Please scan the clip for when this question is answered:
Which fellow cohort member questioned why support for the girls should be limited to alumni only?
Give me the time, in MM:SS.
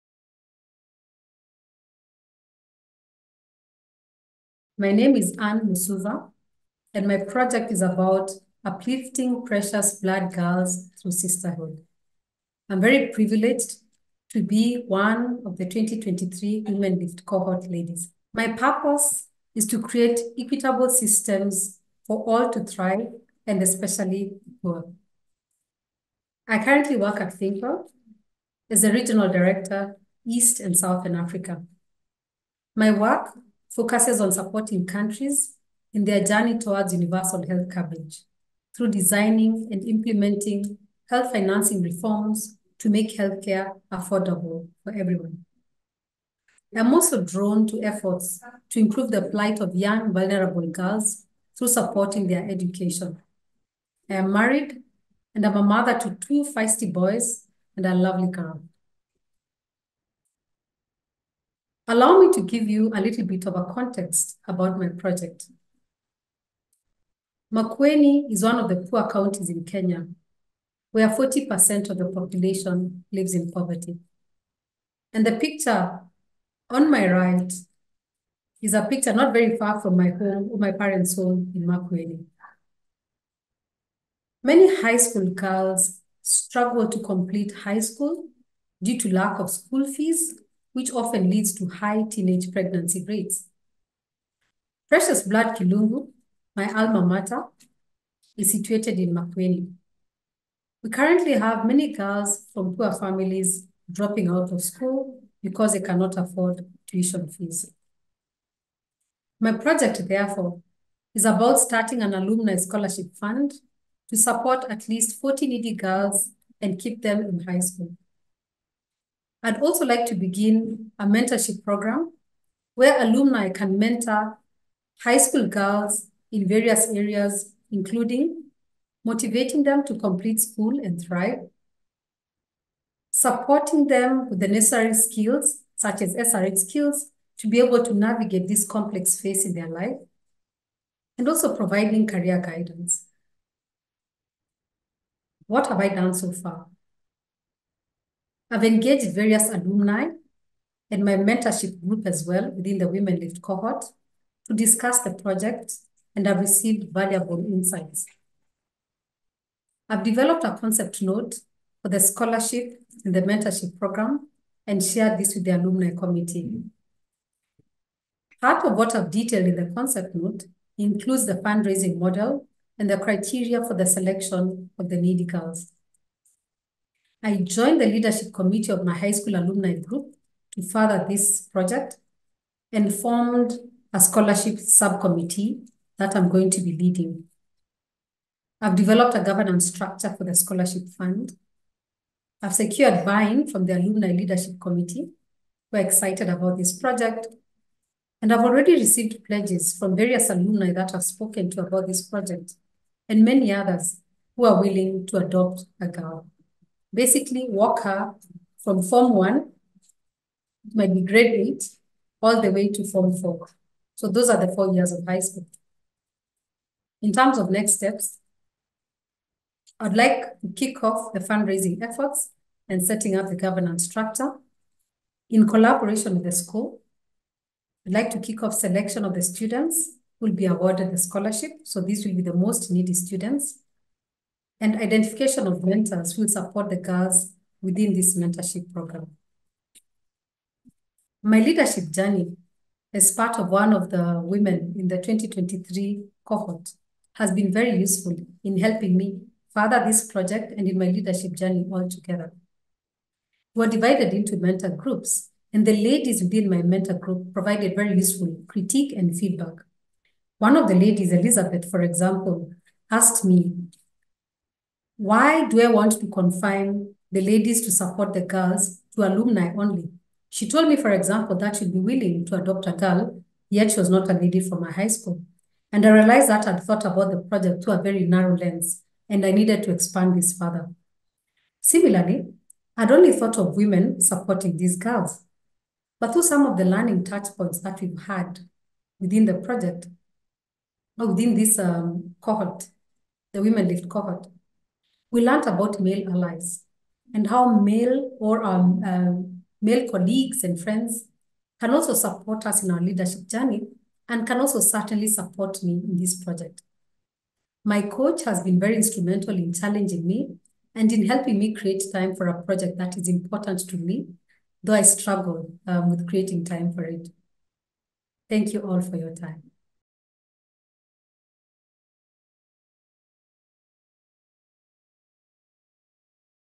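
04:21.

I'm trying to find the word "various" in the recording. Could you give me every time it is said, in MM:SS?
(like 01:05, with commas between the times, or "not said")
02:06, 02:29, 03:19.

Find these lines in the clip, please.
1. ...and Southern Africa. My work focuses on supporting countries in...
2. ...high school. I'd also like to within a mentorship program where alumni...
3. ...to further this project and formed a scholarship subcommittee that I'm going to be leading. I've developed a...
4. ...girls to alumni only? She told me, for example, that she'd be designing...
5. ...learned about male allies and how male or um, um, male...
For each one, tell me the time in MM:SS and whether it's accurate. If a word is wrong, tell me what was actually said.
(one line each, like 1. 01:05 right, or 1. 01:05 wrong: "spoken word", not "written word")
1. 00:30 right
2. 01:57 wrong: "begin", not "within"
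3. 03:00 right
4. 04:28 wrong: "willing", not "designing"
5. 04:55 right.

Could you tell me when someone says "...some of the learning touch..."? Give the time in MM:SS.
04:46.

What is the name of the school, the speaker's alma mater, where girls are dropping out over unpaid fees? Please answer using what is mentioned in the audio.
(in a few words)
Precious Blood Kilungu.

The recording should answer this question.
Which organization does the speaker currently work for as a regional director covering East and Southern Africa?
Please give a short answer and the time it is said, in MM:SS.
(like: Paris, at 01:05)
ThinkWell, at 00:27.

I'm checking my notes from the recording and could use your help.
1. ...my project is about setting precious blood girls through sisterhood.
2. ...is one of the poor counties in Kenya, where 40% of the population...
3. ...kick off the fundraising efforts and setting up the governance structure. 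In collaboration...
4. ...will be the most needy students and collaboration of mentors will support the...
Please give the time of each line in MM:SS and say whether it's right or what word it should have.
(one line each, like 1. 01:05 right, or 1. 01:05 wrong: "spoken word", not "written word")
1. 00:07 wrong: "uplifting", not "setting"
2. 01:08 right
3. 03:40 right
4. 03:52 wrong: "identification", not "collaboration".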